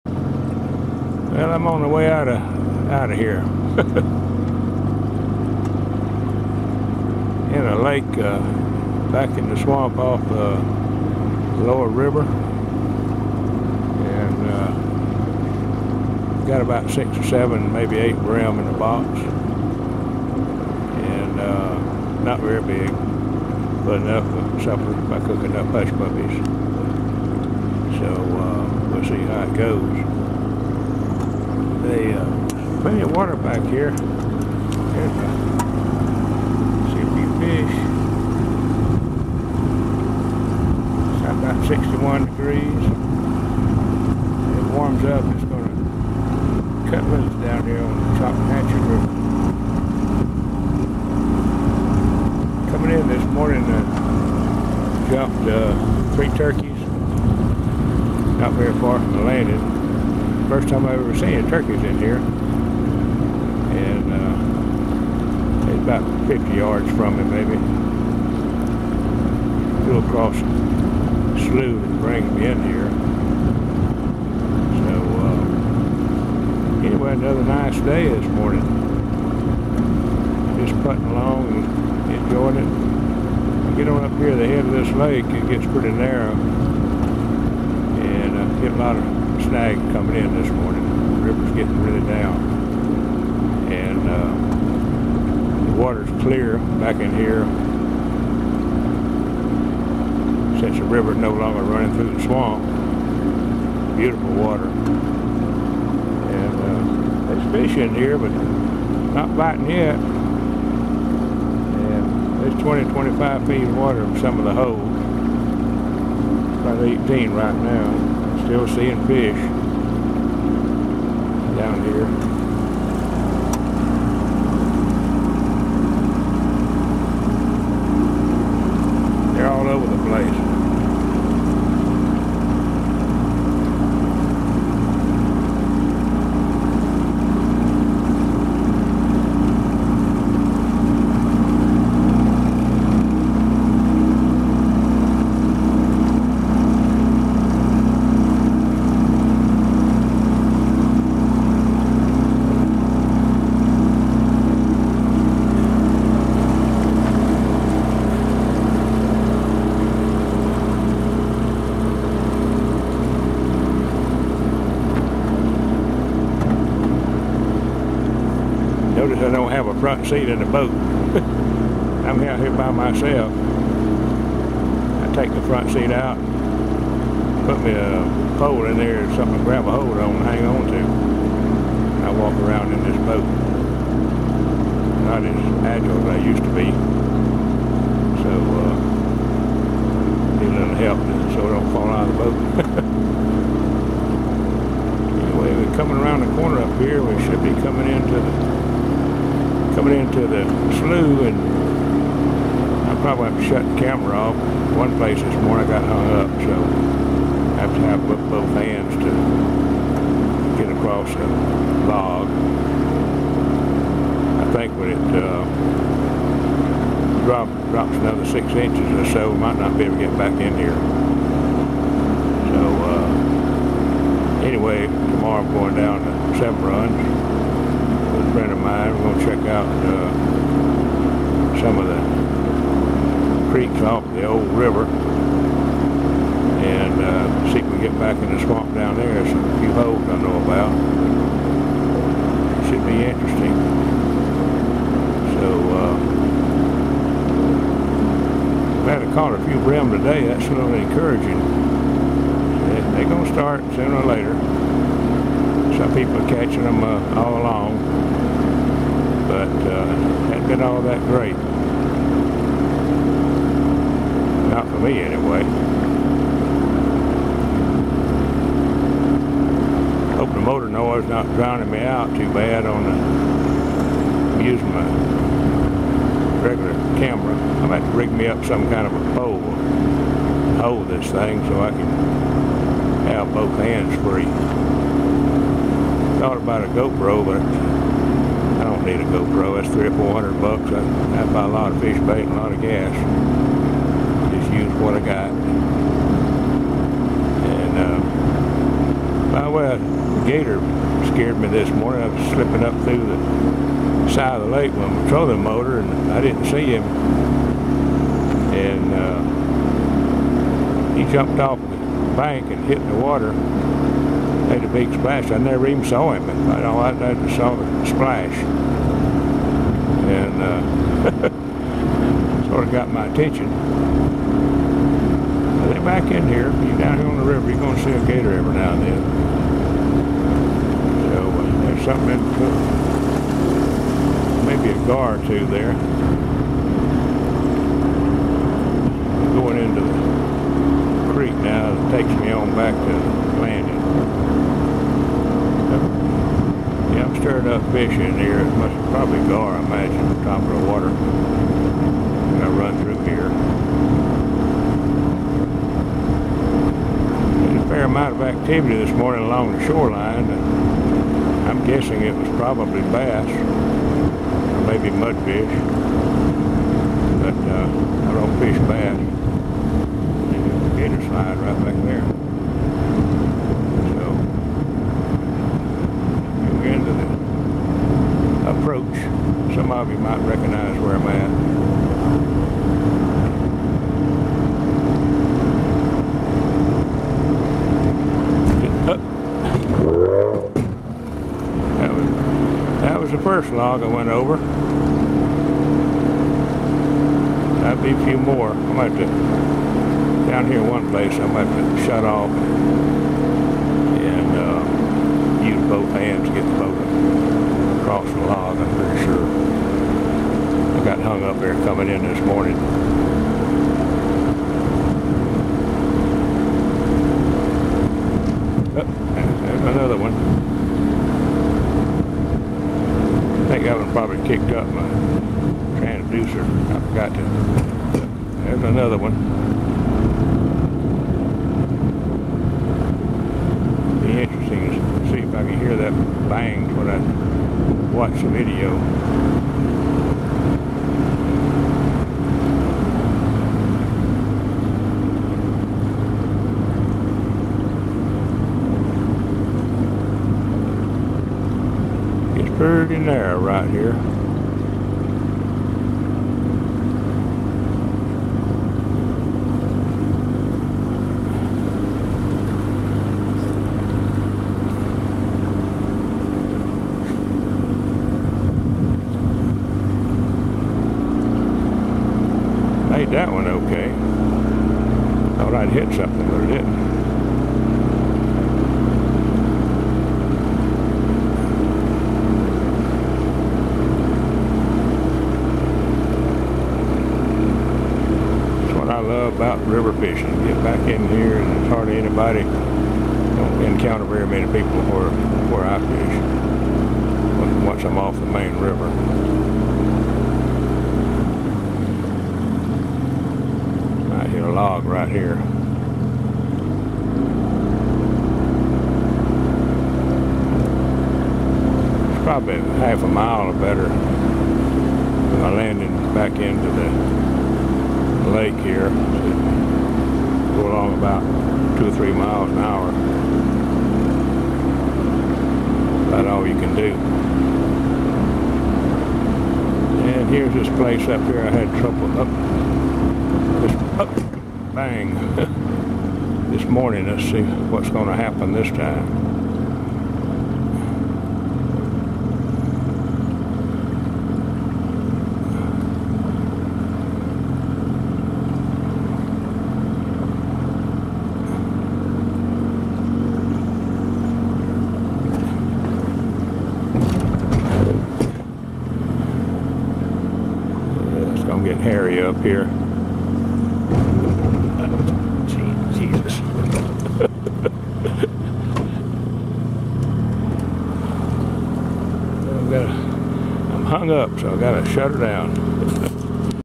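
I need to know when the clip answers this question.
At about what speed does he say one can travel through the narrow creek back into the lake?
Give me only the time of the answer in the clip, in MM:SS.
08:41.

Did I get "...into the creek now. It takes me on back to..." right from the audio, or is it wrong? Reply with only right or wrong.
right.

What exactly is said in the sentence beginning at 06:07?
But uh, I don't fish bass.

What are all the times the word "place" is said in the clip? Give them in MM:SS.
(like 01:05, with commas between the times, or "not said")
03:24, 06:40, 08:50.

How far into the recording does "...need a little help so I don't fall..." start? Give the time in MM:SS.
03:10.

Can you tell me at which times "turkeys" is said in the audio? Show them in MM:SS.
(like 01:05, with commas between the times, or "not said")
00:56, 01:01.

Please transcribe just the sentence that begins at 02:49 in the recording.
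notice I don't have a front seat in the boat.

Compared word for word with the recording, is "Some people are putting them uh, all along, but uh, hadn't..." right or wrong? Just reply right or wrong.
wrong.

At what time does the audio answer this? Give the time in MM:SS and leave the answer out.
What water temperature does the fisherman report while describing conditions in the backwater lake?
00:41.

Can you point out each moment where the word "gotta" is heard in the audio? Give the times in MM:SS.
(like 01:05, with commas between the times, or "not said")
09:34.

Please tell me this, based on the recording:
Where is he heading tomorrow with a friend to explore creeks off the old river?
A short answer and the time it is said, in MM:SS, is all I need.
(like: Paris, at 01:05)
Seven Runs, at 03:46.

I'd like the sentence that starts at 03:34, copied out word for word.
I think when it uh, drop, drops another six inches or so, might not be able to get back in here.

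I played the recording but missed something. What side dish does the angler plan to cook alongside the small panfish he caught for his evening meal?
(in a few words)
hush puppies.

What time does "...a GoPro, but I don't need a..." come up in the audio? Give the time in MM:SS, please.
04:46.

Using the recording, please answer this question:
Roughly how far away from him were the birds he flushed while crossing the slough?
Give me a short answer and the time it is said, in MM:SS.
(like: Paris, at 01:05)
50 yards, at 01:06.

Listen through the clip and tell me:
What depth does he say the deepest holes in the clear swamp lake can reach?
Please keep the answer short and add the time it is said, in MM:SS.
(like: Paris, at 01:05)
20 to 25 feet, at 01:52.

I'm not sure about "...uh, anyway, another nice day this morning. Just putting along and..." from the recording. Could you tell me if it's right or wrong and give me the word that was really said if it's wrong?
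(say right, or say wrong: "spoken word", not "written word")
right.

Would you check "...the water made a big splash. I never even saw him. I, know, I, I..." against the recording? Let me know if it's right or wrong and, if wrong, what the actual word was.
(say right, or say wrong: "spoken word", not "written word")
right.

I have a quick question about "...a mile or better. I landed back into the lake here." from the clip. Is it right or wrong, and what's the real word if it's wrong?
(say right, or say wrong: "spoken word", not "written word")
right.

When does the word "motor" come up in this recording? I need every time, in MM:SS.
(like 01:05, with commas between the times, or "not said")
04:30, 05:05.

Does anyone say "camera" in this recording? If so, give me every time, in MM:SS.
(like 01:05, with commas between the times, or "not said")
03:23, 04:36.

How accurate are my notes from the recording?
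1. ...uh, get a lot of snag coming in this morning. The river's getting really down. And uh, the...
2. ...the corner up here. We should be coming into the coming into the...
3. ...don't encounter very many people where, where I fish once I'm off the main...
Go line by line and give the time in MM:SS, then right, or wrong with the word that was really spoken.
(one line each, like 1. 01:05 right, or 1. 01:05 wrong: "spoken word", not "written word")
1. 01:28 right
2. 03:16 right
3. 08:12 right.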